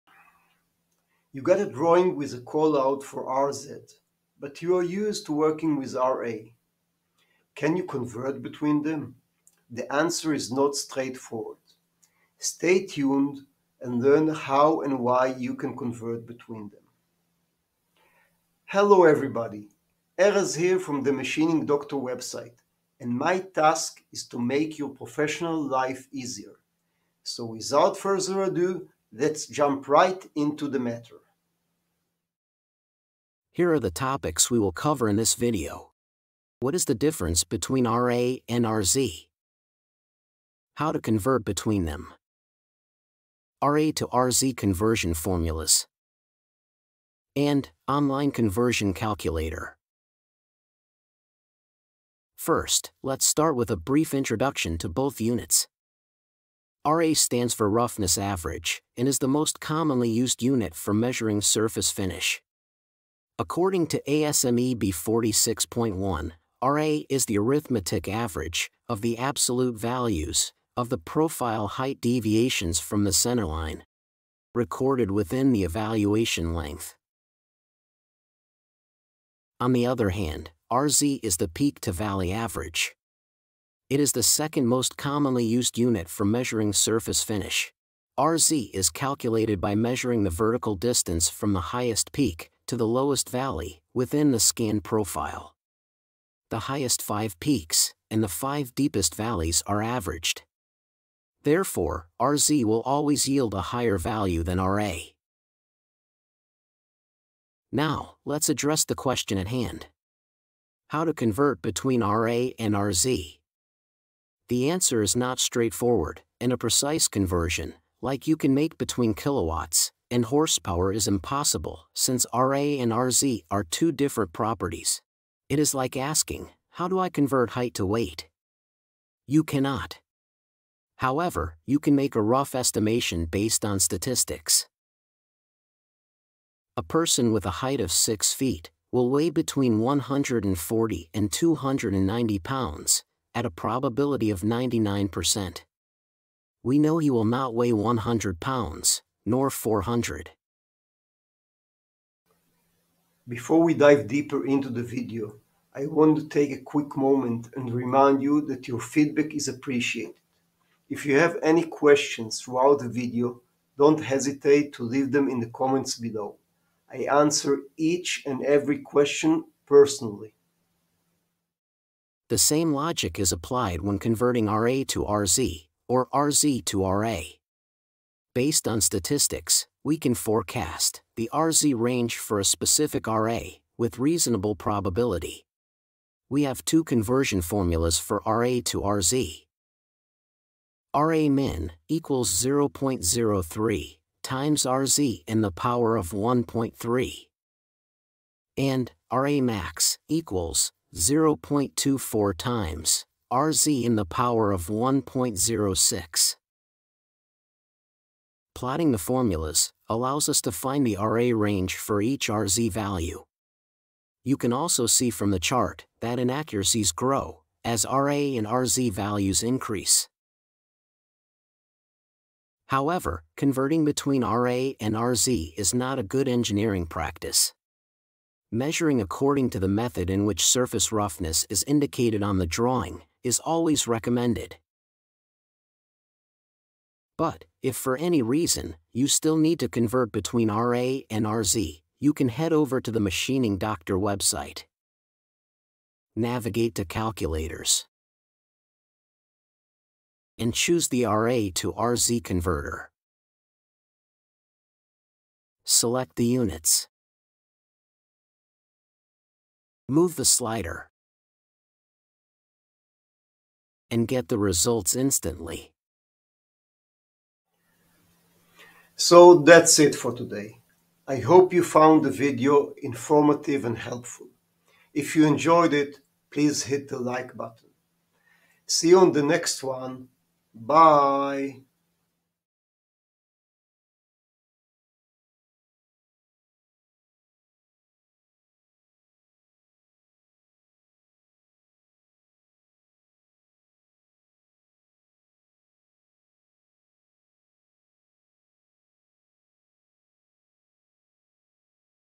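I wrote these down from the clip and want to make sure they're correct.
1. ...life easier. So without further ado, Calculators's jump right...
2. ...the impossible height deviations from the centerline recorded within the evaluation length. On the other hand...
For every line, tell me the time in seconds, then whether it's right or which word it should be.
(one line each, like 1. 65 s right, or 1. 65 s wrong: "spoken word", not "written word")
1. 25 s wrong: "Let", not "Calculators"
2. 70 s wrong: "profile", not "impossible".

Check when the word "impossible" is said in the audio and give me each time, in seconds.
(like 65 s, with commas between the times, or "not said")
121 s.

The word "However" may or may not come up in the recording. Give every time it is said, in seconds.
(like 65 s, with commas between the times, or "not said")
130 s, 222 s.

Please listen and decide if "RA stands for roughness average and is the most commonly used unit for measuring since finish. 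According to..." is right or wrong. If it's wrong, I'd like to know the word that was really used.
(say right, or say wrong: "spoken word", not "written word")
wrong: "surface", not "since".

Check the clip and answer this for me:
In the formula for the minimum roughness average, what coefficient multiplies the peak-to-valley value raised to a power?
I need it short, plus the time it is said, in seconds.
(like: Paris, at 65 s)
0.03, at 192 s.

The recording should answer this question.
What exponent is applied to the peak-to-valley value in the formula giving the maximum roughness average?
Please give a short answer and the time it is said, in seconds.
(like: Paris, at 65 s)
1.06, at 204 s.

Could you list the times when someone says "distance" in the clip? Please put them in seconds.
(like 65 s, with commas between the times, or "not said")
90 s.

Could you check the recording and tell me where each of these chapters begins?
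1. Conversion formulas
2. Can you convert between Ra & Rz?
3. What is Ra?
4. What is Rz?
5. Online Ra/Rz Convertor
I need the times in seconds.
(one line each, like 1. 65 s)
1. 187 s
2. 109 s
3. 56 s
4. 79 s
5. 236 s.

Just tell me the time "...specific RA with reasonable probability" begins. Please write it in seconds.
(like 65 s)
182 s.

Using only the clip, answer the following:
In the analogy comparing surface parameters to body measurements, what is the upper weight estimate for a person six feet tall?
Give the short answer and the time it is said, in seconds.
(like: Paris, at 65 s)
290 pounds, at 141 s.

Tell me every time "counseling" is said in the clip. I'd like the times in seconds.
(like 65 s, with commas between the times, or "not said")
not said.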